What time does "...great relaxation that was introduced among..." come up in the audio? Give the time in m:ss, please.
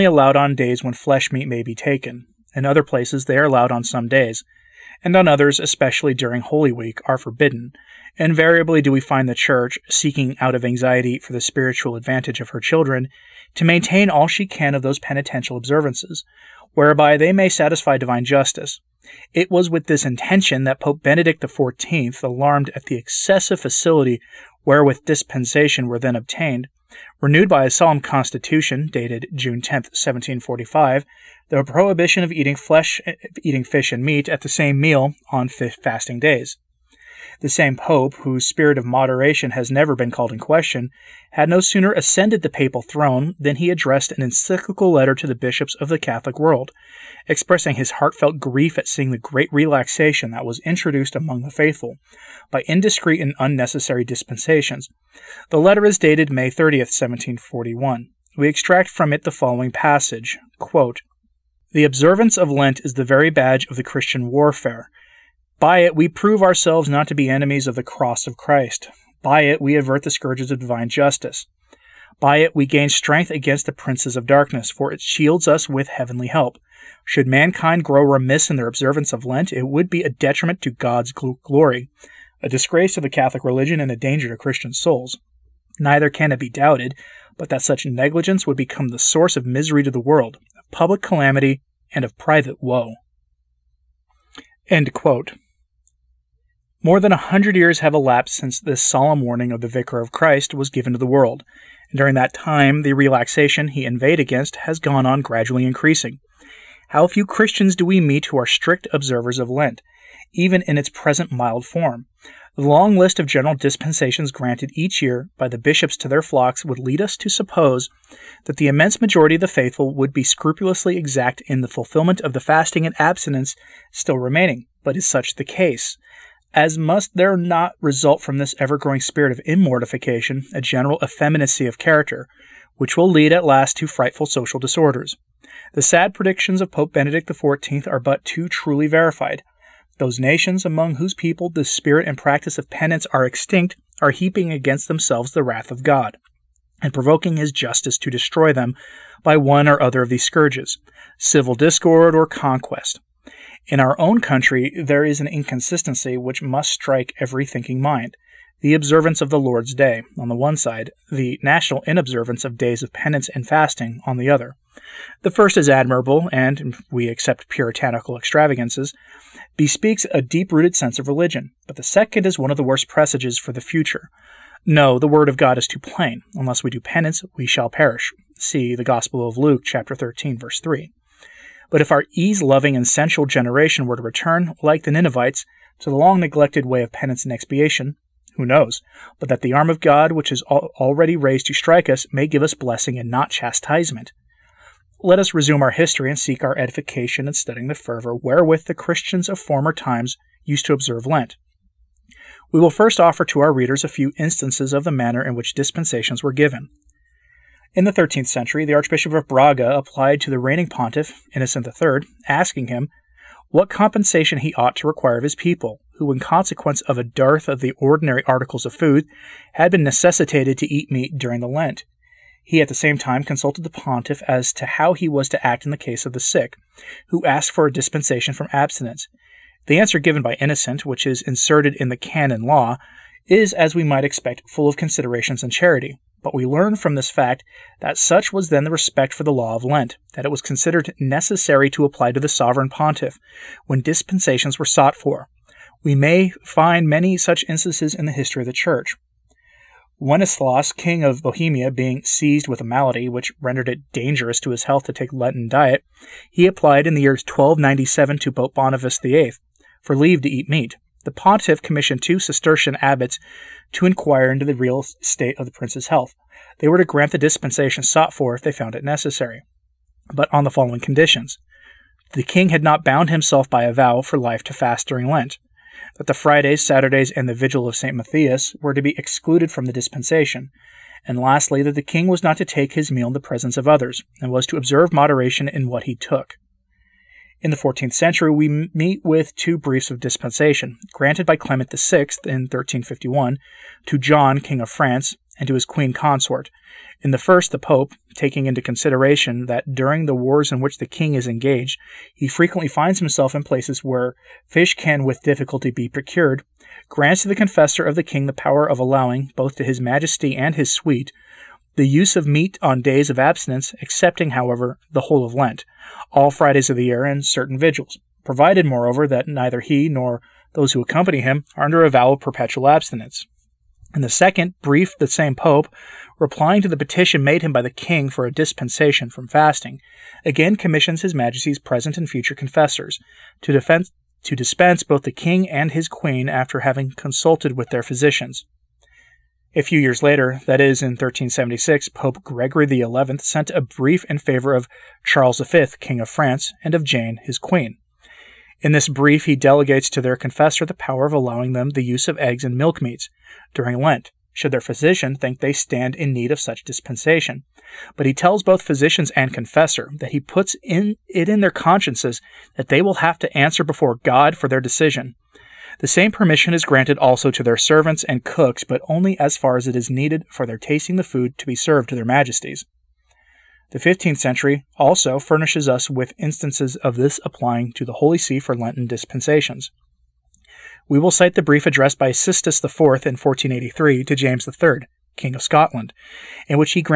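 0:49.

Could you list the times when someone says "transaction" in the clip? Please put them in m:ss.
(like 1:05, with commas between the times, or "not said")
not said.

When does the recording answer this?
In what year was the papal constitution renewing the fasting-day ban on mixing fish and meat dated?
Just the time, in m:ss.
0:29.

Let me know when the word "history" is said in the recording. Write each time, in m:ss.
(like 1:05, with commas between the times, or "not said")
3:15, 4:08.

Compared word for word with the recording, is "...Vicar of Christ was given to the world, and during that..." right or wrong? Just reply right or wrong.
right.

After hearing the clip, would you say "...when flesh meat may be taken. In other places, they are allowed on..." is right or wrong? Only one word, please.
right.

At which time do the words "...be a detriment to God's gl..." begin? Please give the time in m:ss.
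1:19.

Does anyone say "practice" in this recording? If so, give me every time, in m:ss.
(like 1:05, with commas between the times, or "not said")
2:22.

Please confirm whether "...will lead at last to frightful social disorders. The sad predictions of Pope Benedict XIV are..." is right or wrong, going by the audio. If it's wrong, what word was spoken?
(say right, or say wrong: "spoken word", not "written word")
right.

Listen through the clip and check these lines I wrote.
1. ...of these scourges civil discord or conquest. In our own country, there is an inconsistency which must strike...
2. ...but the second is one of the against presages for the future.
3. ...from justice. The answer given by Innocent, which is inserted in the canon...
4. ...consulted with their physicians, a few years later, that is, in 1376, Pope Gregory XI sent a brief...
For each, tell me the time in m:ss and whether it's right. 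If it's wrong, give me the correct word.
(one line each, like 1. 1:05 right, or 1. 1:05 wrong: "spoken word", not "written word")
1. 2:30 right
2. 2:51 wrong: "worst", not "against"
3. 3:48 wrong: "abstinence", not "justice"
4. 5:36 right.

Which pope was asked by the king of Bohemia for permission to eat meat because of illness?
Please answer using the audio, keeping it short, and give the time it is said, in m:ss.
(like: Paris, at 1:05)
Boniface VIII, at 4:18.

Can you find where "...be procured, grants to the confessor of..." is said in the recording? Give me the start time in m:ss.
5:05.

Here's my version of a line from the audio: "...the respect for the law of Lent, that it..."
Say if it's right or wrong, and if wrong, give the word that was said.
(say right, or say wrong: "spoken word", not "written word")
right.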